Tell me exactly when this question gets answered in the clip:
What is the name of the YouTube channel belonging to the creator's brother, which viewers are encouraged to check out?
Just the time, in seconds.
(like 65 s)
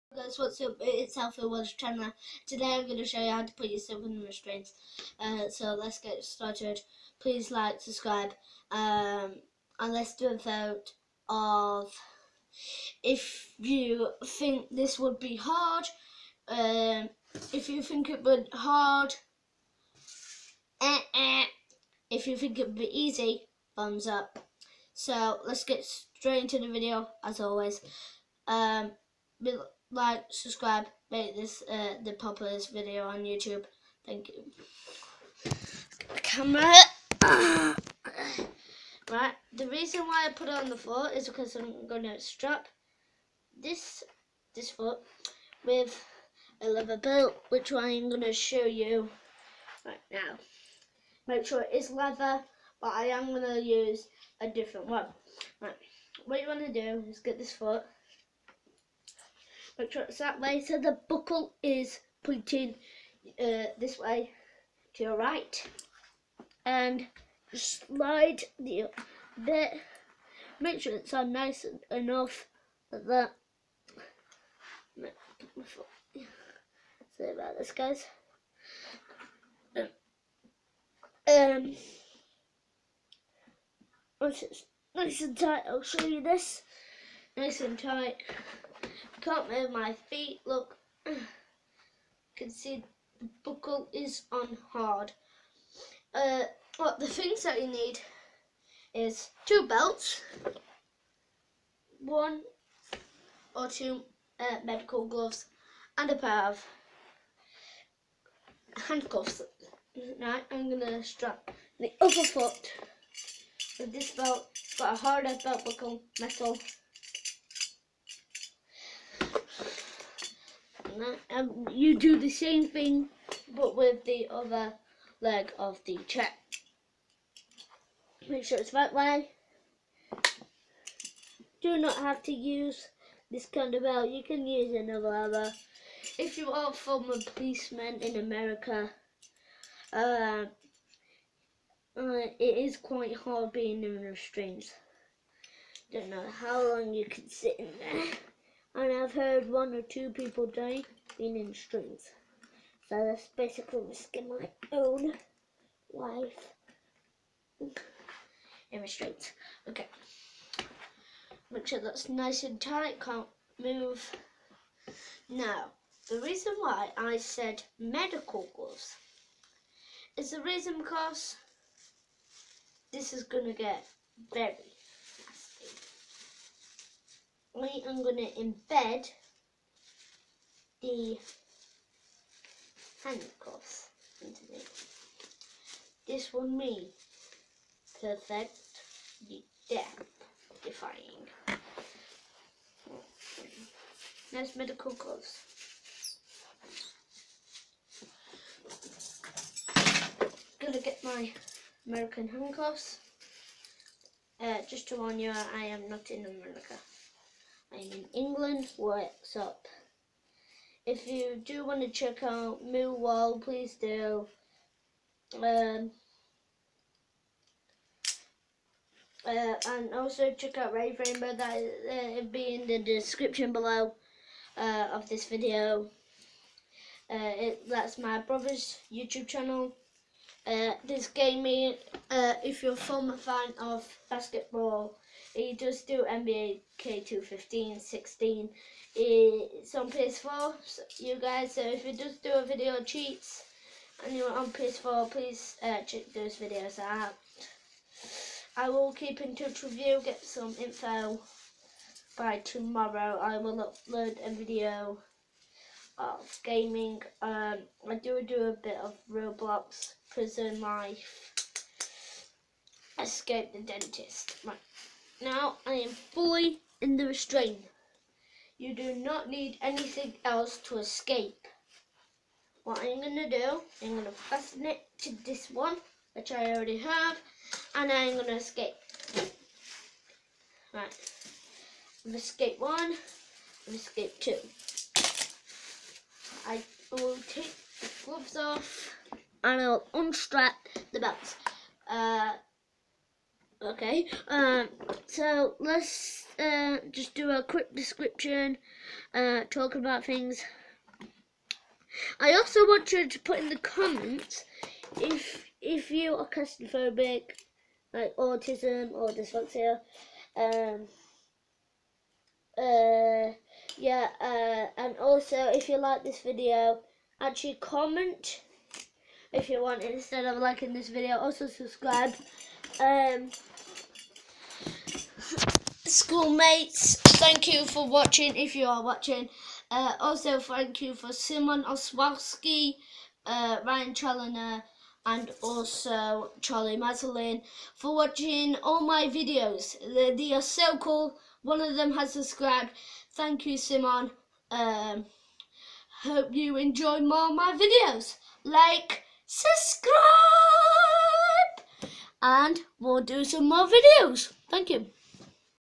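220 s.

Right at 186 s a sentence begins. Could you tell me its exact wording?
This will mean perfect death defying.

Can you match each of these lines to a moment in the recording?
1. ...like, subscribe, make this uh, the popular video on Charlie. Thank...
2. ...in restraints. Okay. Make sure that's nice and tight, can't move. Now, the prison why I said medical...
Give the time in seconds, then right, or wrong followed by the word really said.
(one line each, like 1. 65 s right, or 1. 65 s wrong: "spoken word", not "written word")
1. 29 s wrong: "YouTube", not "Charlie"
2. 158 s wrong: "reason", not "prison".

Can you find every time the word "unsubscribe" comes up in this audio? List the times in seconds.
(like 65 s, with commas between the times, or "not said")
not said.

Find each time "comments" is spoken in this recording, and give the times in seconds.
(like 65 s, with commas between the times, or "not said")
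303 s, 317 s.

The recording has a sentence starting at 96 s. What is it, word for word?
Uh, what the things that you need is two belts, one or two uh, medical gloves, and a pair of handcuffs.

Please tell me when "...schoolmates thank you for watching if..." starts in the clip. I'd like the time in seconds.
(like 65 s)
325 s.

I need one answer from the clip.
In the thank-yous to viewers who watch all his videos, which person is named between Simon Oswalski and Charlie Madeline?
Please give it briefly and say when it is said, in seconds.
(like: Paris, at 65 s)
Ryan Challoner, at 333 s.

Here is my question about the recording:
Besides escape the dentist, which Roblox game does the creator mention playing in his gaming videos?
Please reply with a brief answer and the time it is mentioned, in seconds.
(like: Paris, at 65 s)
Prison Life, at 260 s.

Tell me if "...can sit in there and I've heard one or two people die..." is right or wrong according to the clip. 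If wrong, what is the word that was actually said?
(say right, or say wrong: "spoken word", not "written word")
right.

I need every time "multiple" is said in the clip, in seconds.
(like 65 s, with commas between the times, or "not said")
not said.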